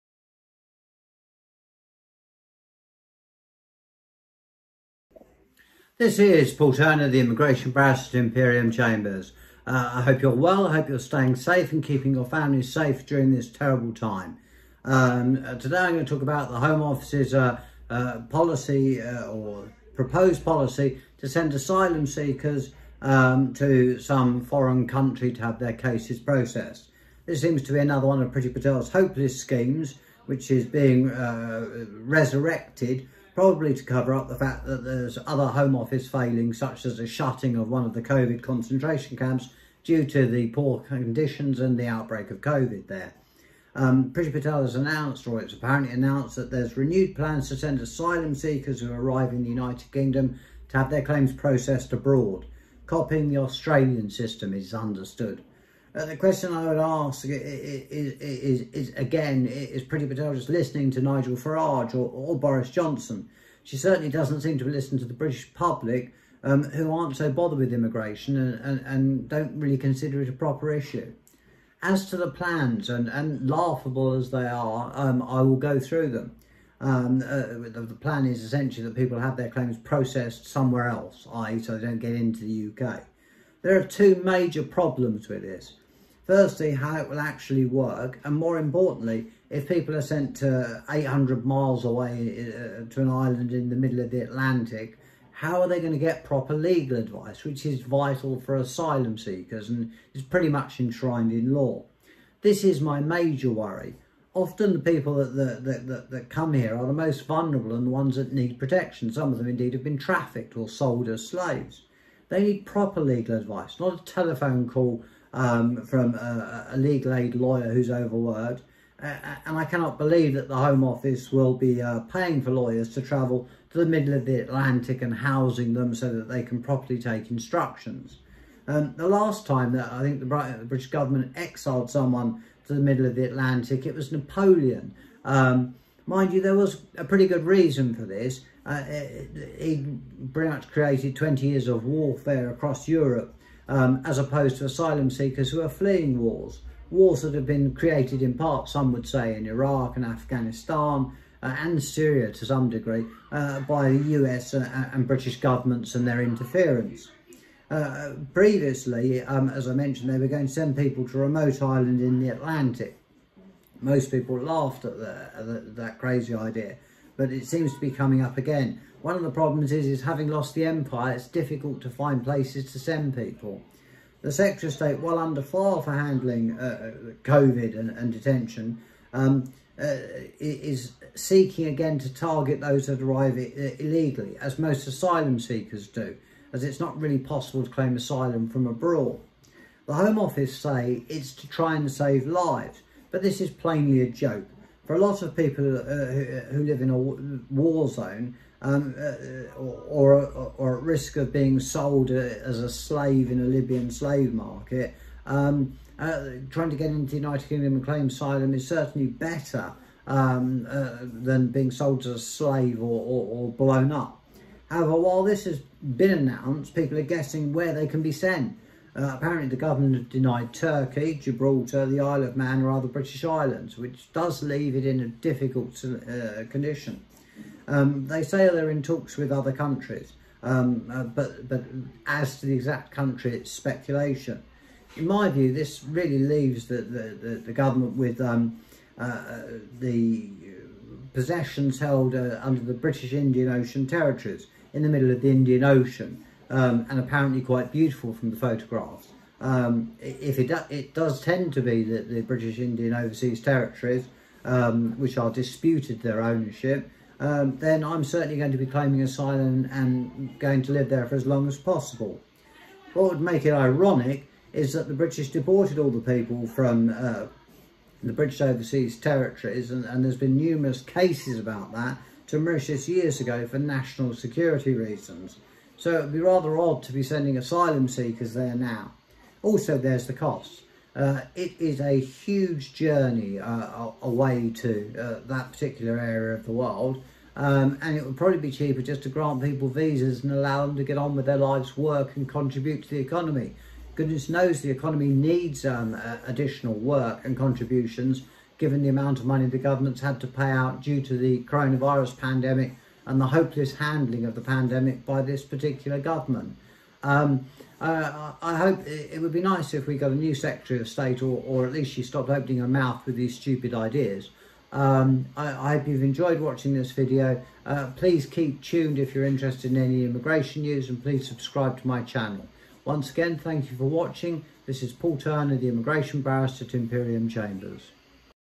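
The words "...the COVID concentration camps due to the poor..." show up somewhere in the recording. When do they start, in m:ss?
0:37.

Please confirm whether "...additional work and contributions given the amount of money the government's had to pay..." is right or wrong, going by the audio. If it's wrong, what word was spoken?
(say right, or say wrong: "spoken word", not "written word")
right.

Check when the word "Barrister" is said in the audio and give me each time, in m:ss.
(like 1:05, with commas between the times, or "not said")
0:07, 5:26.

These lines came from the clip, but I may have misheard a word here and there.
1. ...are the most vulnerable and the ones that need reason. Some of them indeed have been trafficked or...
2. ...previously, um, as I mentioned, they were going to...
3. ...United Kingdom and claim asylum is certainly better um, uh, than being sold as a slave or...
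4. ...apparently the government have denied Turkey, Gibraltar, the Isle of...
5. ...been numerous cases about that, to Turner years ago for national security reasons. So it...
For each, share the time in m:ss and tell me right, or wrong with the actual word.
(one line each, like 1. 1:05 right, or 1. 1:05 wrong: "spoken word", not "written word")
1. 1:46 wrong: "protection", not "reason"
2. 2:38 right
3. 3:27 right
4. 3:39 right
5. 4:30 wrong: "Mauritius", not "Turner".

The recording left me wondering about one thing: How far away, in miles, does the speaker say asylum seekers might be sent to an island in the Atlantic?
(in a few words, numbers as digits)
800 miles.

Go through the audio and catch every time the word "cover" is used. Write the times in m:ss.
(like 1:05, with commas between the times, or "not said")
0:33.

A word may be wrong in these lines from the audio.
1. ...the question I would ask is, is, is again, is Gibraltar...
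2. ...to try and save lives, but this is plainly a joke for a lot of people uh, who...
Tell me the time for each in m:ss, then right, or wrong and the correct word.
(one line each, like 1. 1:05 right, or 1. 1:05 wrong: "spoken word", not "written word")
1. 0:56 wrong: "Priti", not "Gibraltar"
2. 3:11 right.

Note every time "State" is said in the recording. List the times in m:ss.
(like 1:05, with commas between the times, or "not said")
2:54, 5:10.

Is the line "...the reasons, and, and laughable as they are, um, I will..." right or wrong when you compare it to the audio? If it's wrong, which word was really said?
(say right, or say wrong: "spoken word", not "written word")
wrong: "plans", not "reasons".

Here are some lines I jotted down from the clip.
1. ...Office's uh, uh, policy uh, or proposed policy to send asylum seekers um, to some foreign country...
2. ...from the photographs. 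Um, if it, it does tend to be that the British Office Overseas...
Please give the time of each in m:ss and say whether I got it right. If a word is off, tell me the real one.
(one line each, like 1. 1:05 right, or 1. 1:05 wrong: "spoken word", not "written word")
1. 0:16 right
2. 4:08 wrong: "Indian", not "Office".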